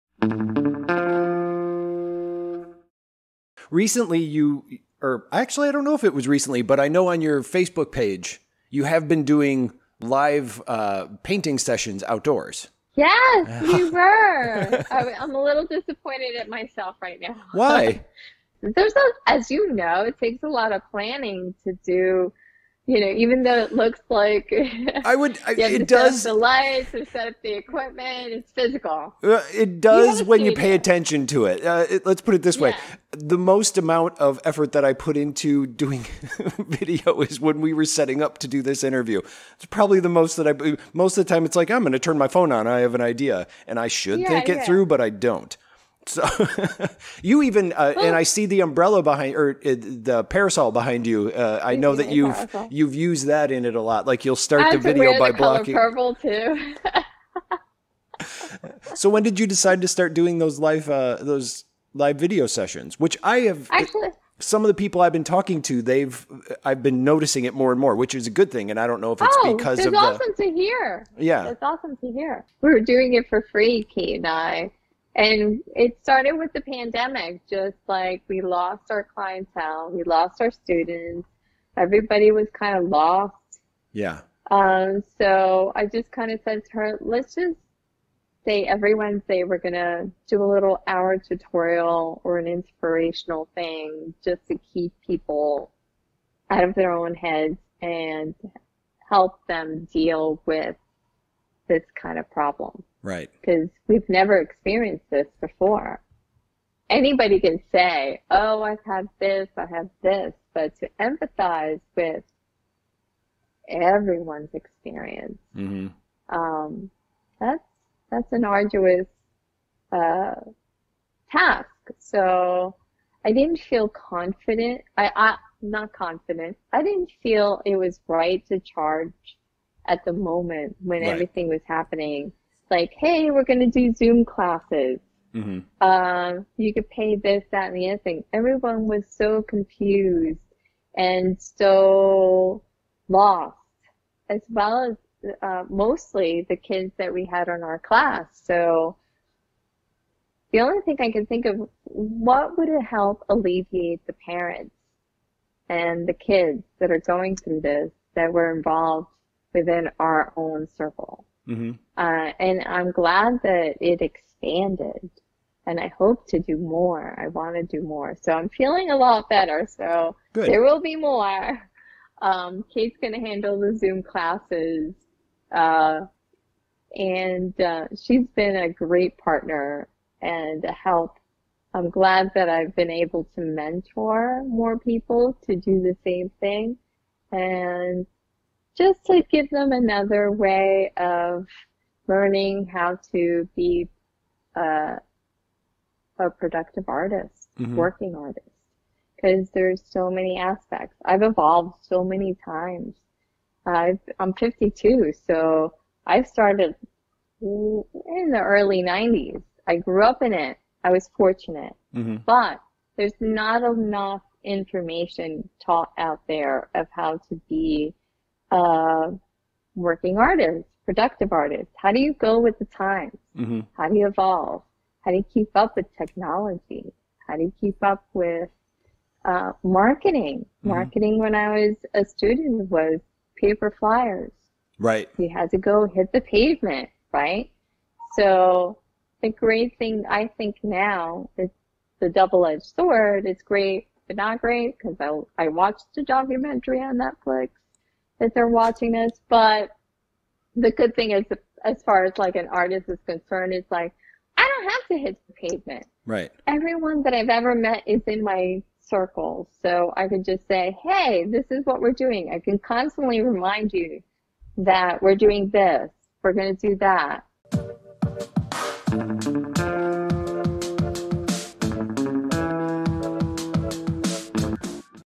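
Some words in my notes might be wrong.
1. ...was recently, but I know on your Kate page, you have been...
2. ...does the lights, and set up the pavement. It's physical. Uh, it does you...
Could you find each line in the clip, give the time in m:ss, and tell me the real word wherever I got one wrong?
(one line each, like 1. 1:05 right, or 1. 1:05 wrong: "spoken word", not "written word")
1. 0:06 wrong: "Facebook", not "Kate"
2. 0:25 wrong: "equipment", not "pavement".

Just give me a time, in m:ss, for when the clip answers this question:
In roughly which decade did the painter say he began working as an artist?
3:28.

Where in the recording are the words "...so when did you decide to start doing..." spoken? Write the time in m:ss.
0:58.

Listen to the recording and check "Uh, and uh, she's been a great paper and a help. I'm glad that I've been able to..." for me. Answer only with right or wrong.
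wrong.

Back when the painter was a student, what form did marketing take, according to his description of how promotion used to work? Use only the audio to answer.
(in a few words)
paper flyers.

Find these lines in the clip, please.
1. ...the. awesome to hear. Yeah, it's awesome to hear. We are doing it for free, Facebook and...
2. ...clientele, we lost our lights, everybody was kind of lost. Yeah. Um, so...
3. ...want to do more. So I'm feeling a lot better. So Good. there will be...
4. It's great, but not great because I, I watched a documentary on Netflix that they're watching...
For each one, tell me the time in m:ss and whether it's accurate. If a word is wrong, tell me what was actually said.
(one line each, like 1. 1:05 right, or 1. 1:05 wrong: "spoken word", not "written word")
1. 1:10 wrong: "Kate", not "Facebook"
2. 1:19 wrong: "students", not "lights"
3. 2:47 right
4. 4:03 right.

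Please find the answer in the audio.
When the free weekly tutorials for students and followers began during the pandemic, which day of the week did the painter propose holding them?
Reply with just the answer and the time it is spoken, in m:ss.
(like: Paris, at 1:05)
Wednesday, at 1:28.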